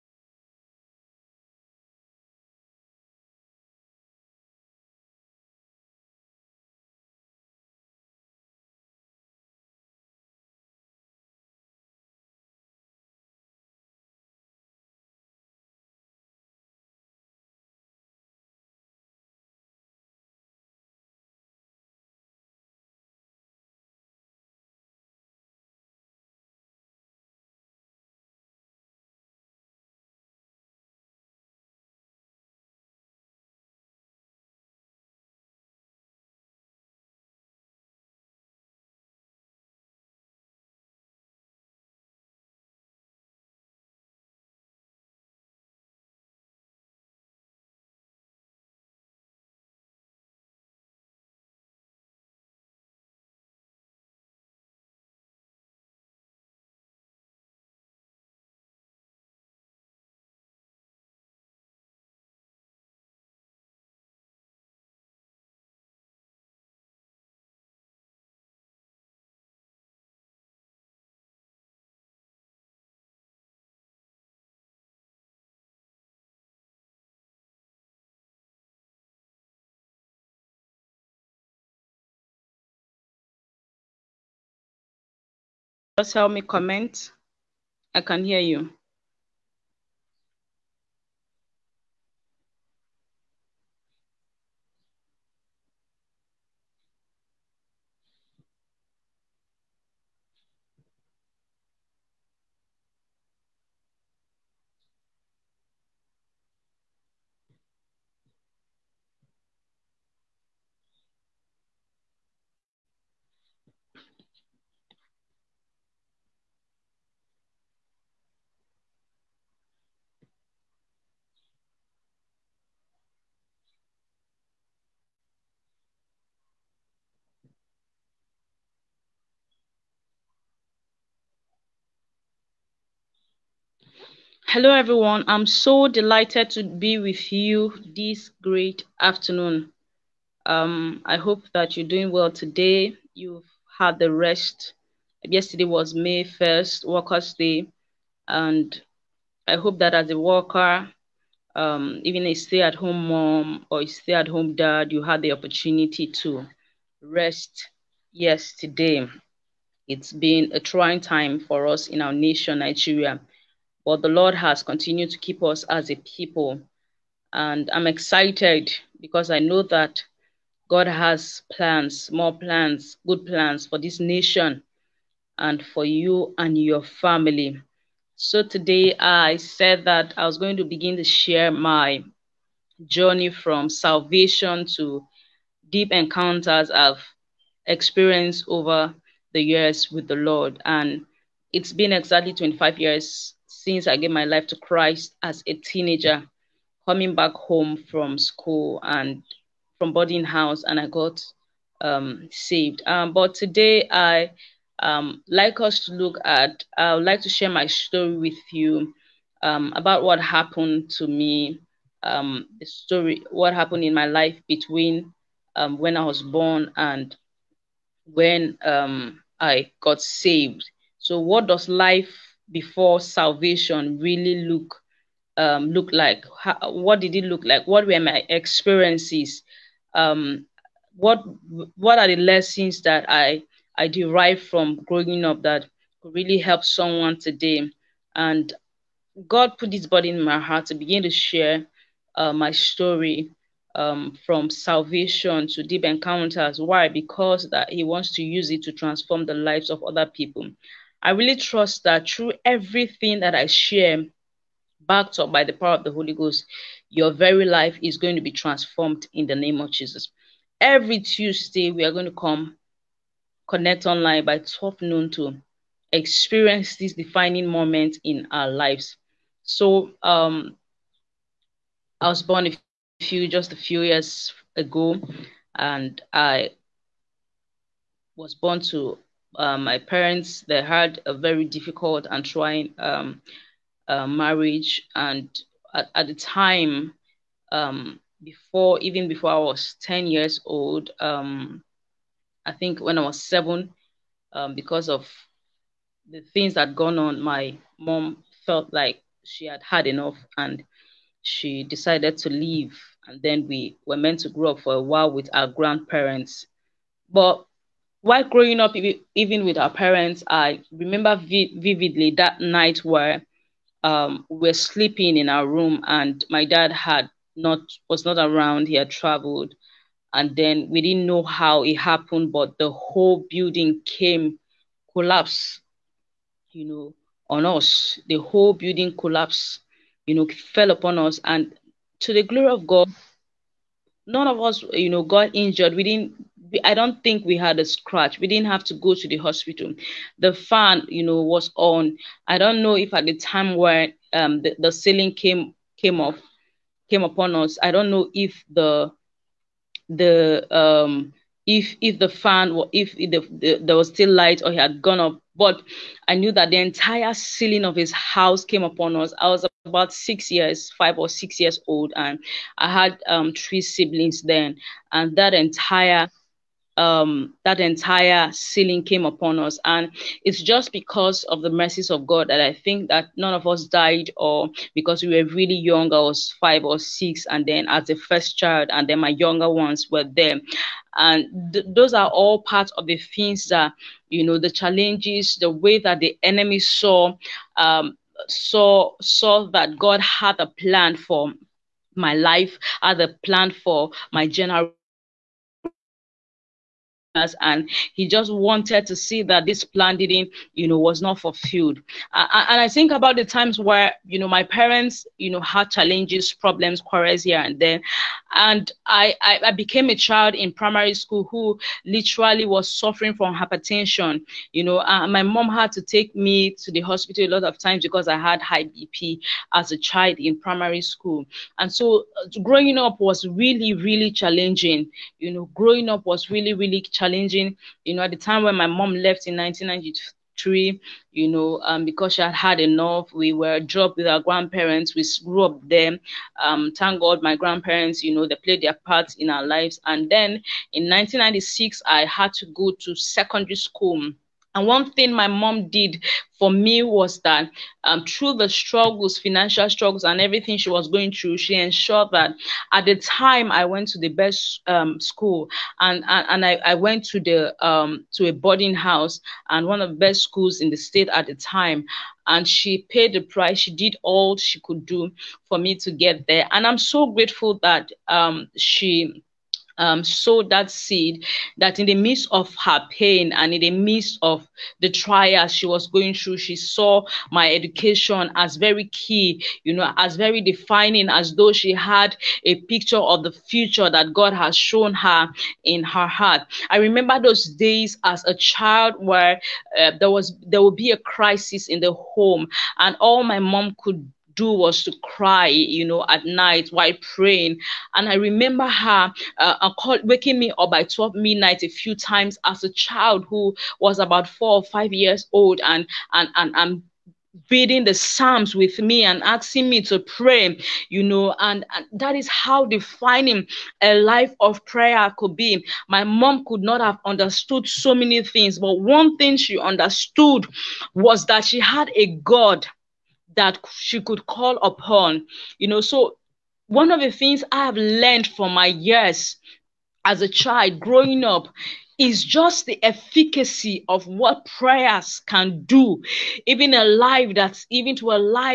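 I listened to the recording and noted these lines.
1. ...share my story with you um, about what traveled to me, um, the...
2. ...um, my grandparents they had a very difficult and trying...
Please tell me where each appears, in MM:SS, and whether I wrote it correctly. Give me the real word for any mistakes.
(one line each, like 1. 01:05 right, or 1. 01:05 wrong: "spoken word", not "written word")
1. 03:27 wrong: "happened", not "traveled"
2. 04:39 wrong: "parents", not "grandparents".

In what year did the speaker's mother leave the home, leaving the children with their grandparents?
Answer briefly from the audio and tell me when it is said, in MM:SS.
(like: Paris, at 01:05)
1993, at 07:09.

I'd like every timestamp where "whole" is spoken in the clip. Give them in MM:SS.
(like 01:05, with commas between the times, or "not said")
05:22, 05:28.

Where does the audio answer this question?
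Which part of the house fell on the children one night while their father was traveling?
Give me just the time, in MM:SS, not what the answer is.
05:56.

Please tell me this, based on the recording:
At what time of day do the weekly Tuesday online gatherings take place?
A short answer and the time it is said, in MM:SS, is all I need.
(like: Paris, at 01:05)
12 noon, at 04:24.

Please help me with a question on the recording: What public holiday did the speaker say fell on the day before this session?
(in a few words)
Workers' Day.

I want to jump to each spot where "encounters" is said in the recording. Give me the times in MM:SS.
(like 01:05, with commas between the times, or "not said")
03:05, 04:05.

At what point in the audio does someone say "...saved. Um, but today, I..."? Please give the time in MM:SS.
03:22.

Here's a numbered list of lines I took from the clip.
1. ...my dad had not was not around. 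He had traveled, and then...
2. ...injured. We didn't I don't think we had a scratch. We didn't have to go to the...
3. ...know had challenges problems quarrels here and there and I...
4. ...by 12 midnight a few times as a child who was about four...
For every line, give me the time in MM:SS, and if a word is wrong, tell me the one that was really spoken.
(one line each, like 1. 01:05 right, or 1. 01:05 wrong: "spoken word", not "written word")
1. 05:16 right
2. 05:35 right
3. 06:45 right
4. 08:20 right.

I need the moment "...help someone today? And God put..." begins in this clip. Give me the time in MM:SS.
03:56.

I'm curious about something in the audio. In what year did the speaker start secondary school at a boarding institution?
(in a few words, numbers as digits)
1996.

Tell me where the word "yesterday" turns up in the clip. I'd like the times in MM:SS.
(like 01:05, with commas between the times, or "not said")
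02:25, 02:38.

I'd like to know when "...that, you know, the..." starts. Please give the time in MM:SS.
06:23.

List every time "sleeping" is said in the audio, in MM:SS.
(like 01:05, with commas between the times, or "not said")
05:14.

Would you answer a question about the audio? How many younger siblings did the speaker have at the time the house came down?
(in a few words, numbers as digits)
3.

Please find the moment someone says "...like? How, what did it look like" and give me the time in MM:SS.
03:45.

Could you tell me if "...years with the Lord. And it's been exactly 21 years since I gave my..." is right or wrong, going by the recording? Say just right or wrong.
wrong.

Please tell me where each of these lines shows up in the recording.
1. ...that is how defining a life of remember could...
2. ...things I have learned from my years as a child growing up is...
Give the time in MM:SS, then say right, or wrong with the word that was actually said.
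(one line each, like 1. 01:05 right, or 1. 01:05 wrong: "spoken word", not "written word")
1. 08:31 wrong: "prayer", not "remember"
2. 08:47 right.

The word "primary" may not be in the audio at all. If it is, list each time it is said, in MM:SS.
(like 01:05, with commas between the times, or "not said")
06:50, 07:00.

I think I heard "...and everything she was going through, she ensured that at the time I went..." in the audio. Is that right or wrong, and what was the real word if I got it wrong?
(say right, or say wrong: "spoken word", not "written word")
right.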